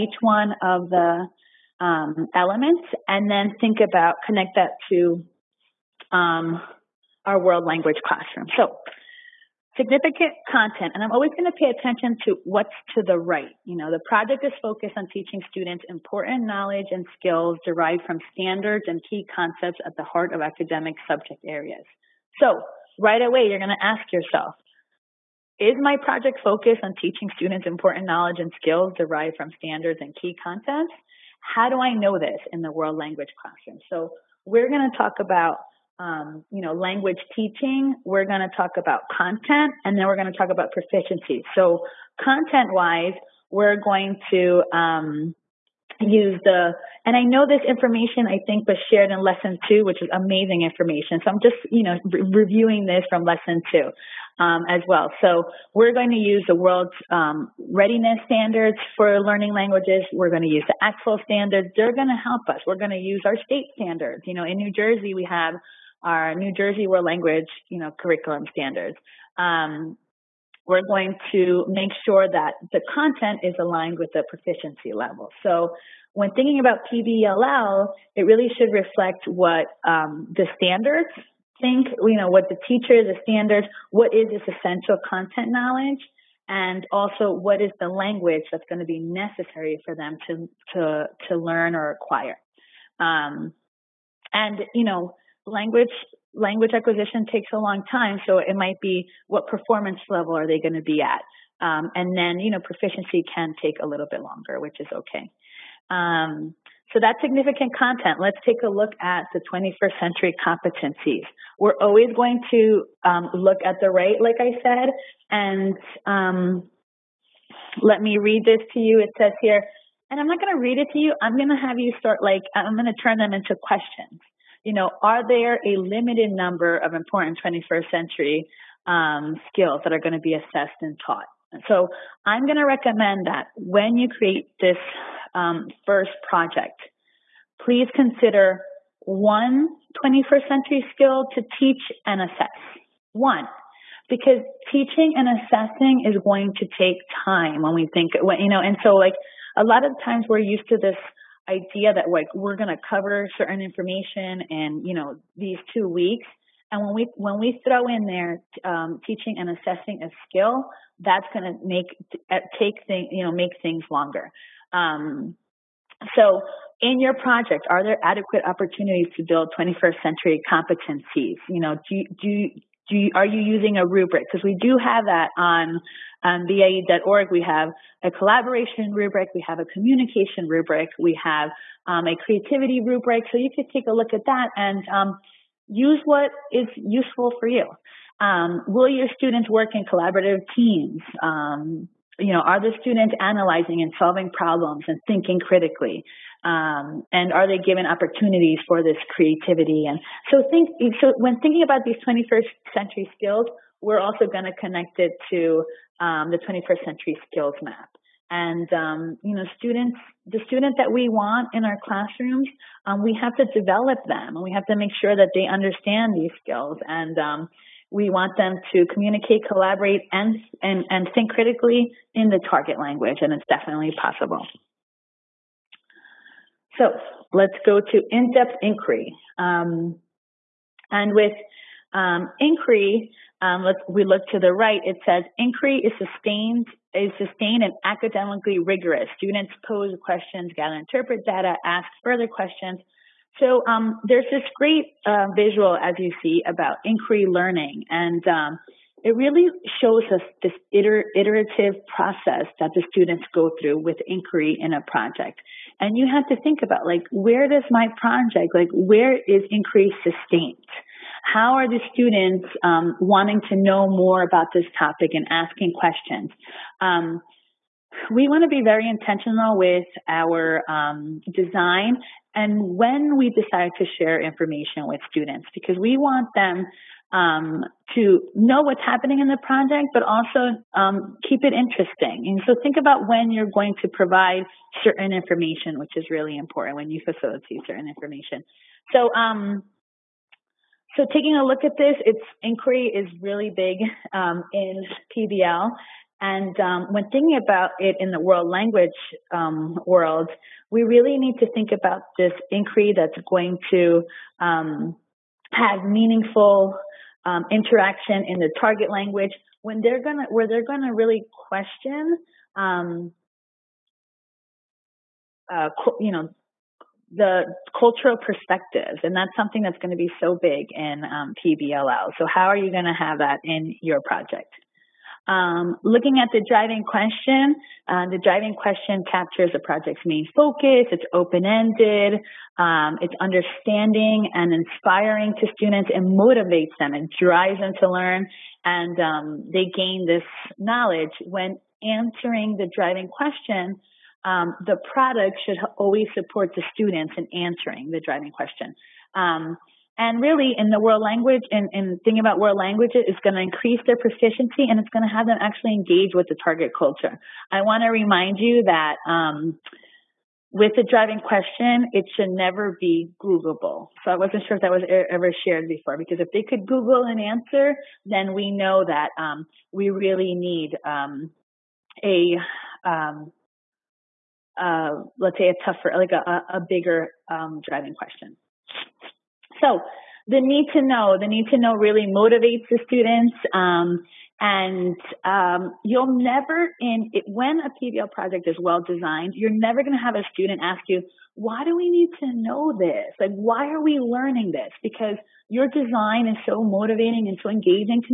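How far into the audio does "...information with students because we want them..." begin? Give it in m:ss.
4:34.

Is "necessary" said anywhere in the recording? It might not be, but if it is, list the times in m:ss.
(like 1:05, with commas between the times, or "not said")
1:28.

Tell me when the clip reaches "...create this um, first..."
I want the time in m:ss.
2:14.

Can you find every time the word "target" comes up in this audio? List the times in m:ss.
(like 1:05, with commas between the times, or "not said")
3:42, 5:08, 5:56.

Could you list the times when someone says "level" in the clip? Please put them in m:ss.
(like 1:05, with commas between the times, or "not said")
1:14, 1:40.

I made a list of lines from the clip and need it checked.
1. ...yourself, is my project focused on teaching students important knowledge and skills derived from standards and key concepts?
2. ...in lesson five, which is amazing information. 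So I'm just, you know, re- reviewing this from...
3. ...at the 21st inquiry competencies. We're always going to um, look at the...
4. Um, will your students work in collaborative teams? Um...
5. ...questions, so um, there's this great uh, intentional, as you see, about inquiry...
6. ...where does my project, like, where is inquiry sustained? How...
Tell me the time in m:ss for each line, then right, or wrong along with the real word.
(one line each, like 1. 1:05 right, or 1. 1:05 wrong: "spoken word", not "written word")
1. 0:24 right
2. 0:49 wrong: "two", not "five"
3. 1:49 wrong: "century", not "inquiry"
4. 3:08 right
5. 4:02 wrong: "visual", not "intentional"
6. 4:17 right.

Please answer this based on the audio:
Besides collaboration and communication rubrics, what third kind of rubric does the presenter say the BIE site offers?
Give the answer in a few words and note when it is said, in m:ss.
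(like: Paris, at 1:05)
creativity rubric, at 3:02.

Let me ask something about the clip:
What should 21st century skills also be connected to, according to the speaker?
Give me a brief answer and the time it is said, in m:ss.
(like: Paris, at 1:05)
21st century skills map, at 3:26.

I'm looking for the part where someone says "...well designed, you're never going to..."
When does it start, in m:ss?
6:28.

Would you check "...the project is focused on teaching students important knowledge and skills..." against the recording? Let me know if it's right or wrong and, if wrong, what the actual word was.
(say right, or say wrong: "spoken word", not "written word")
right.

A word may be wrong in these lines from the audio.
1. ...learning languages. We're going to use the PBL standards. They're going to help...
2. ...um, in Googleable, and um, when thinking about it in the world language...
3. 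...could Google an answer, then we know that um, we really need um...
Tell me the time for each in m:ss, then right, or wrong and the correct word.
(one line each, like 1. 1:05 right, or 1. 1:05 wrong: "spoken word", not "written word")
1. 0:59 wrong: "ACTFL", not "PBL"
2. 4:54 wrong: "PBL", not "Googleable"
3. 6:06 right.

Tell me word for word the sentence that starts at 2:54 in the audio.
Because we do have that on um, BIE.org.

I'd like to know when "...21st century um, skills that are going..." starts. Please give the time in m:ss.
2:07.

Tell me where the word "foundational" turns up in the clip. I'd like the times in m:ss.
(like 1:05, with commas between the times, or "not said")
not said.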